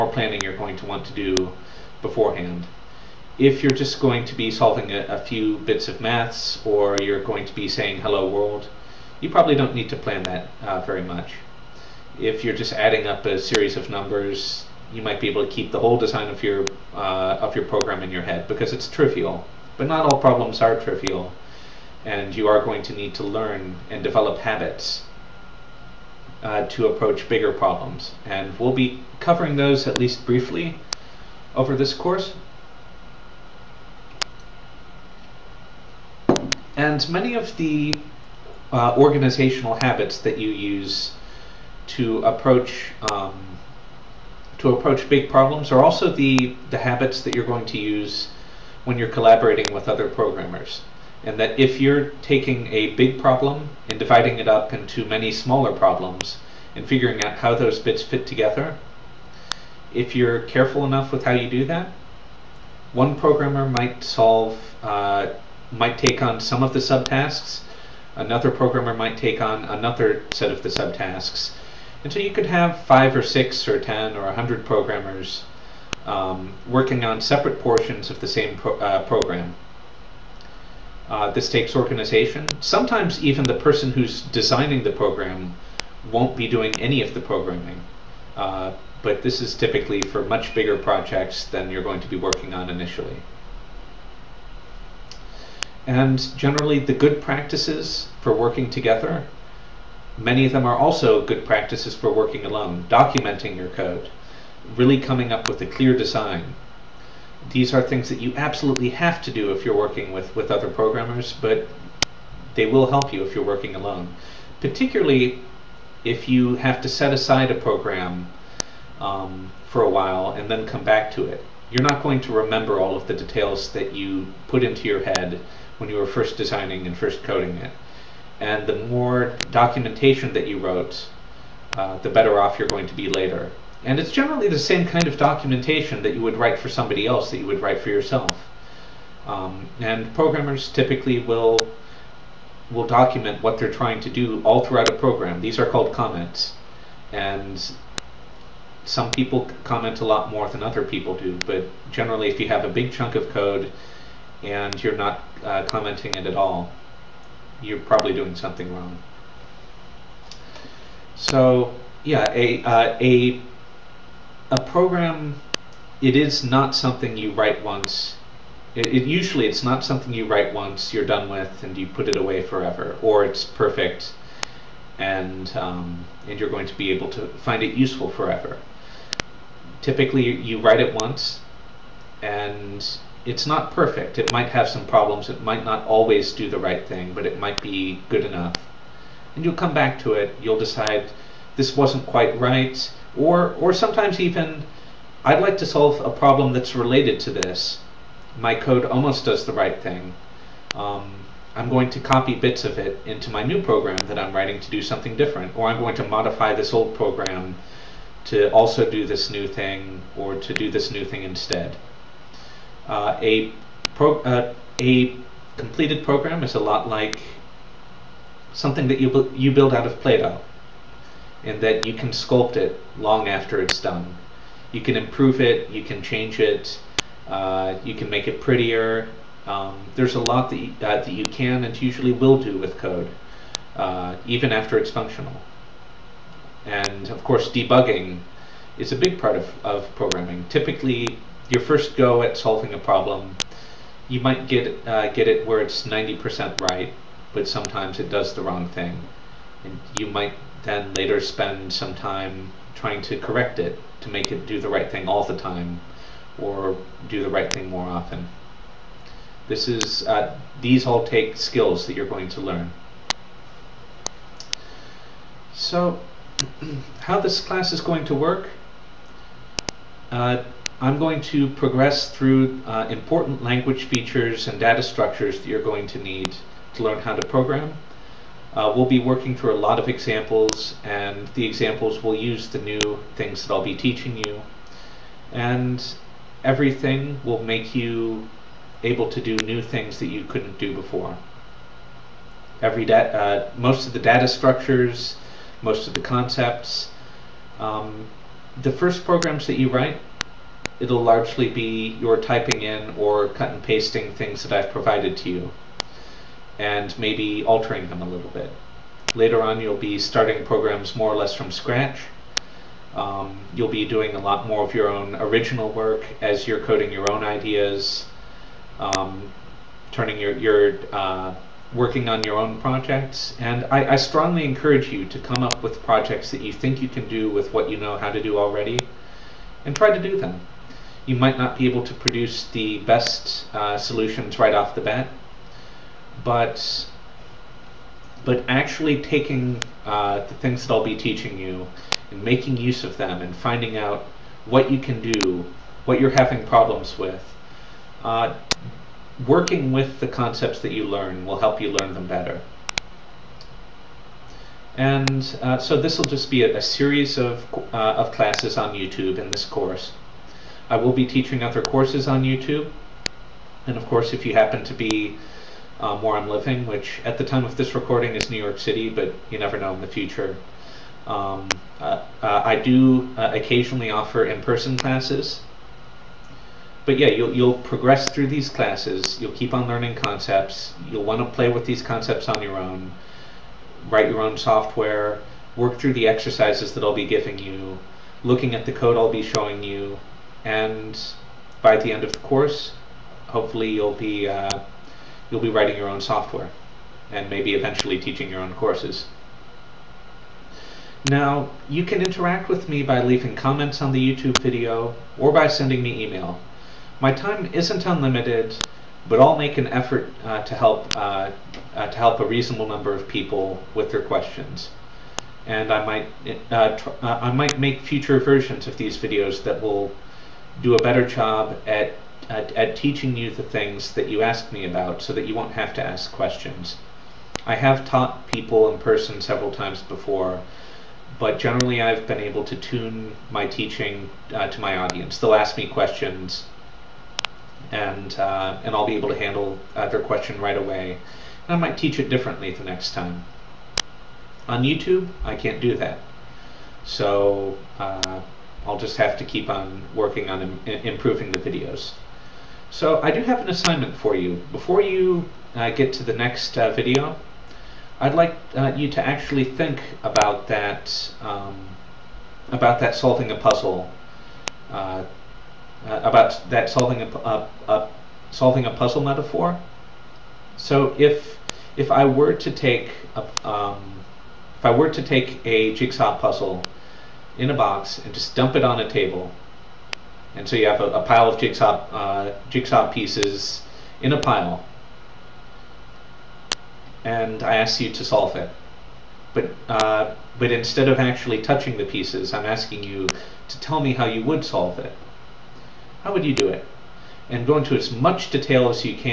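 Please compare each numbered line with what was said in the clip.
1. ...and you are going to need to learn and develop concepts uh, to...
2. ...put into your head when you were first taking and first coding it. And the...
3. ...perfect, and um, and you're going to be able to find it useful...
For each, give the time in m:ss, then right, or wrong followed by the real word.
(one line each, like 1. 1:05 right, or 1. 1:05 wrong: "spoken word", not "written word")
1. 0:22 wrong: "habits", not "concepts"
2. 2:04 wrong: "designing", not "taking"
3. 2:53 right.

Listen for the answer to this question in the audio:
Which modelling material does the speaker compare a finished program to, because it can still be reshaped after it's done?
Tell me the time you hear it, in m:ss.
3:39.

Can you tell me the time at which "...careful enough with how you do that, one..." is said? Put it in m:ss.
1:00.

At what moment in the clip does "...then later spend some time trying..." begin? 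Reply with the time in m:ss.
4:10.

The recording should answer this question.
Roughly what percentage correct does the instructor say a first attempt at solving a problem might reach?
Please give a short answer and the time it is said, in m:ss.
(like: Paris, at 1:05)
90%, at 4:05.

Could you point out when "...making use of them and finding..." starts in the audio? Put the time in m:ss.
5:42.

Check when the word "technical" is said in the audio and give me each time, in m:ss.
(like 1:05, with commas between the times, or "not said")
not said.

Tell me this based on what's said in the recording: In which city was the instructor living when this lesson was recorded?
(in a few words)
New York City.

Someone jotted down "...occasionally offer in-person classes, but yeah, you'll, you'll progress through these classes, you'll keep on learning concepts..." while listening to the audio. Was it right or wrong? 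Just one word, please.
right.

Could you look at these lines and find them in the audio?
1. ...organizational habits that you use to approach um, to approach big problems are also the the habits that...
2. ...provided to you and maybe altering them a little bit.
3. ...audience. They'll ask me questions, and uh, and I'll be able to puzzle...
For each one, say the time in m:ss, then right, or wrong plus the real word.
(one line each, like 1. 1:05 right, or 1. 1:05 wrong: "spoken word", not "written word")
1. 0:38 right
2. 5:04 right
3. 7:14 wrong: "handle", not "puzzle".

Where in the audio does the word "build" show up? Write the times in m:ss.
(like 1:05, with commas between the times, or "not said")
3:39.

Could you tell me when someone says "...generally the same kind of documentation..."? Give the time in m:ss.
2:14.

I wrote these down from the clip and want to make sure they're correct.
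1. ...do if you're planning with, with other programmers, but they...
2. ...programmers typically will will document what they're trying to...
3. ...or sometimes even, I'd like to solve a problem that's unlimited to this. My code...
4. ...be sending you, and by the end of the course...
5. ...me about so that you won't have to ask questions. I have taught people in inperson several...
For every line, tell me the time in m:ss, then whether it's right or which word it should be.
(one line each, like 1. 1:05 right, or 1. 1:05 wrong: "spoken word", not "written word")
1. 1:49 wrong: "working", not "planning"
2. 2:20 right
3. 3:13 wrong: "related", not "unlimited"
4. 6:29 wrong: "showing", not "sending"
5. 7:04 wrong: "person", not "inperson".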